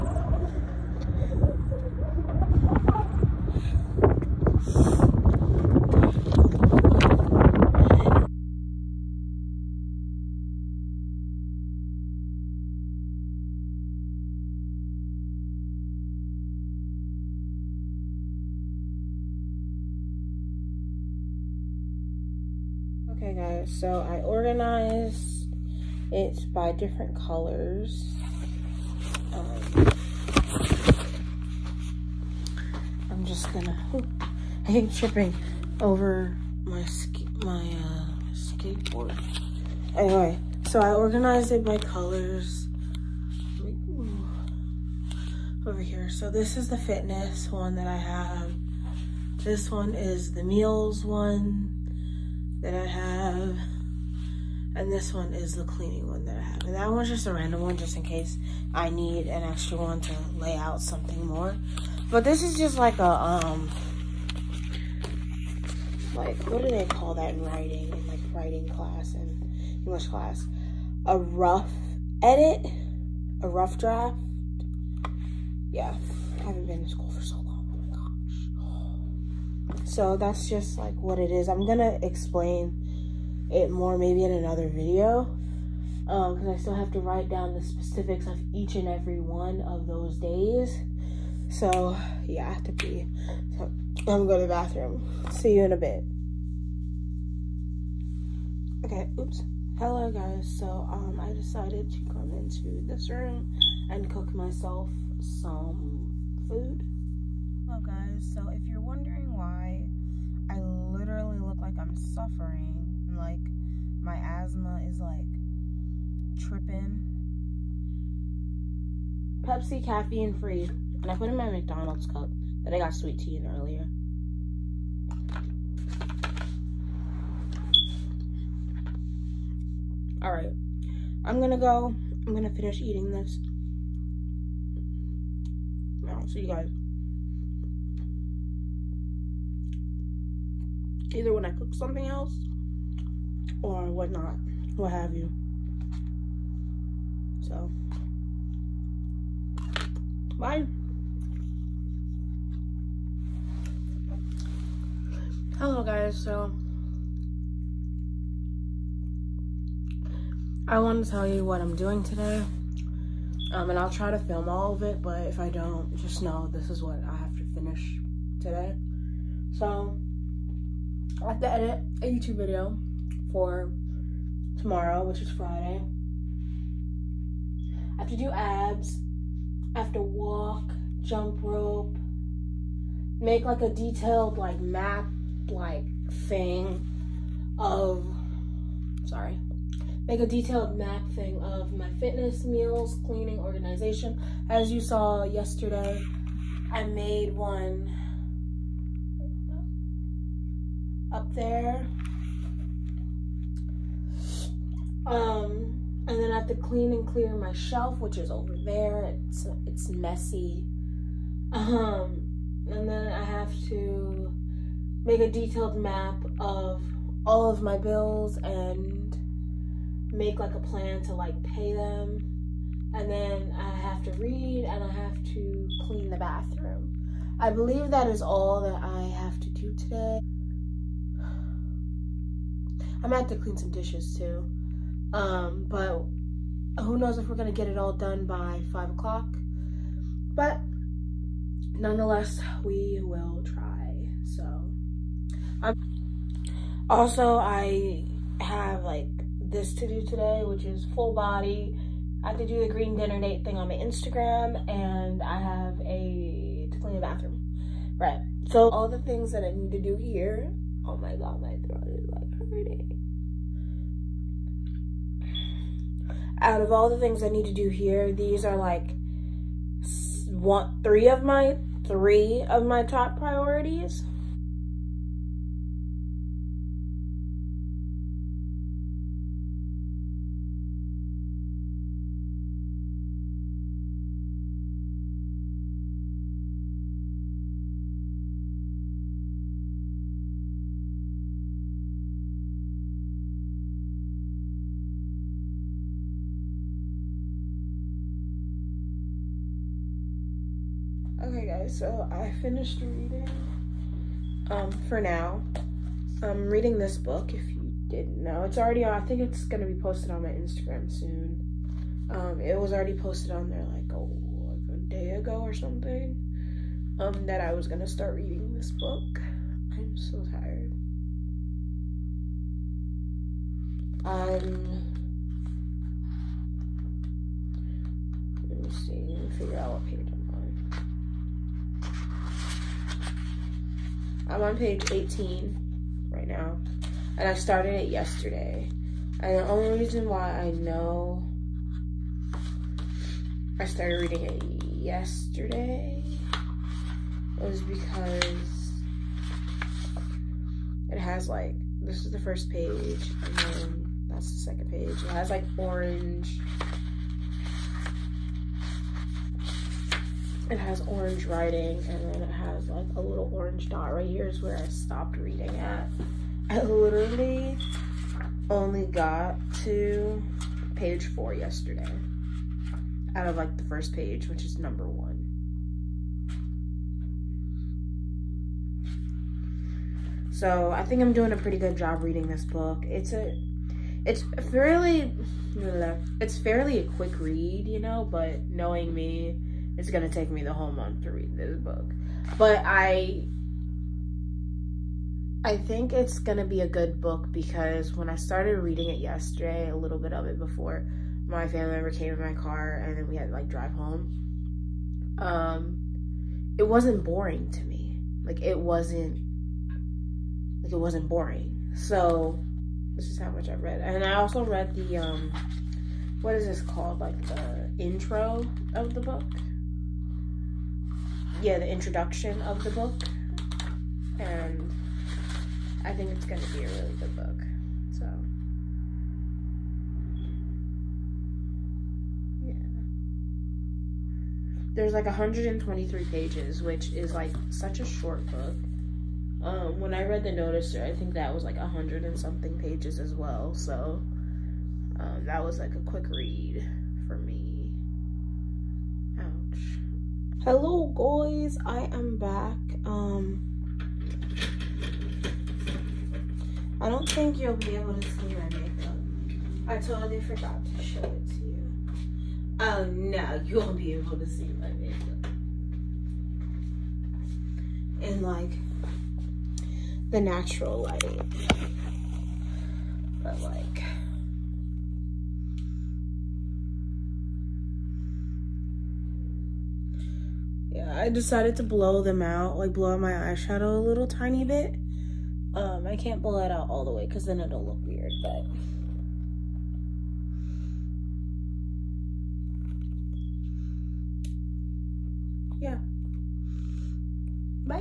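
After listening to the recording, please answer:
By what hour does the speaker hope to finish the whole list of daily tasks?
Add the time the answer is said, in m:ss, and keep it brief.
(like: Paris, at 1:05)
5 o'clock, at 3:58.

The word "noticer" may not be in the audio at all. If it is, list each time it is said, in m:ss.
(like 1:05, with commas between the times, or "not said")
7:20.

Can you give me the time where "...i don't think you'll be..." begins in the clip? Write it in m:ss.
7:36.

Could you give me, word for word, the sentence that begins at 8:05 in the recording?
Um, I can't blow it out all the way because then it'll look weird, but...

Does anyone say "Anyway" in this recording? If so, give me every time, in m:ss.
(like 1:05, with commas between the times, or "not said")
0:39.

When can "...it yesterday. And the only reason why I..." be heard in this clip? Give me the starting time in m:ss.
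5:37.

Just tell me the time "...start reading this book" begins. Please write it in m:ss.
5:17.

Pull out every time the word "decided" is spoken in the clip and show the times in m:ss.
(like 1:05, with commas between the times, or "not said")
1:41, 8:01.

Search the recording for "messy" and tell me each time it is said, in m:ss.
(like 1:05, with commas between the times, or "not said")
3:29.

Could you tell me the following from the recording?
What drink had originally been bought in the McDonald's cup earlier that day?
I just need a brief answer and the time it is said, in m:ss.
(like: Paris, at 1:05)
sweet tea, at 2:02.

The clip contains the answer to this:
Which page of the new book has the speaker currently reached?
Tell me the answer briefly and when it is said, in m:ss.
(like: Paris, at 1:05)
18, at 5:34.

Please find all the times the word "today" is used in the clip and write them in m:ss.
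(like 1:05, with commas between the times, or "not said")
2:42, 2:48, 3:49, 4:10.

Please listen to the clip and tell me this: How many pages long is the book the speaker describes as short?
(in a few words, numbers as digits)
123.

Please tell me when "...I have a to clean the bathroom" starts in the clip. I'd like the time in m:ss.
4:15.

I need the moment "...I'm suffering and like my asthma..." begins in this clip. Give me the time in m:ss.
1:51.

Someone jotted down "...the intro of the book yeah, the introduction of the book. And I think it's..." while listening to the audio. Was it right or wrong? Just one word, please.
right.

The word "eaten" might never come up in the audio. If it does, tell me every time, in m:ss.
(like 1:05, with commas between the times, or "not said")
not said.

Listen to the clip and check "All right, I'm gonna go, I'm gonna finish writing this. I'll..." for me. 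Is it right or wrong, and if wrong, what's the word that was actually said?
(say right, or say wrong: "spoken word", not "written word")
wrong: "eating", not "writing".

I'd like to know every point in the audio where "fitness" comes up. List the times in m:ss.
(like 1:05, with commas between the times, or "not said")
0:46, 3:11.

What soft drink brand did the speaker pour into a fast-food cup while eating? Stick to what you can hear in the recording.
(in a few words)
Pepsi.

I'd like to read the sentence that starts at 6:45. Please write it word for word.
Um it wasn't boring to me.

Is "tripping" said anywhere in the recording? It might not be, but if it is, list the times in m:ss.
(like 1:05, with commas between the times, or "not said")
0:34, 1:56.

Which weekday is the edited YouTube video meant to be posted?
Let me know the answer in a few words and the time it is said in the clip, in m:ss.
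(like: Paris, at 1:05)
Friday, at 2:55.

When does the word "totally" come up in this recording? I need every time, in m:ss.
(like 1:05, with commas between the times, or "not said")
7:39.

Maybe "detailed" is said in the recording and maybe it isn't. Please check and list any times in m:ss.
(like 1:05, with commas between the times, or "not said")
3:03, 3:10, 3:35.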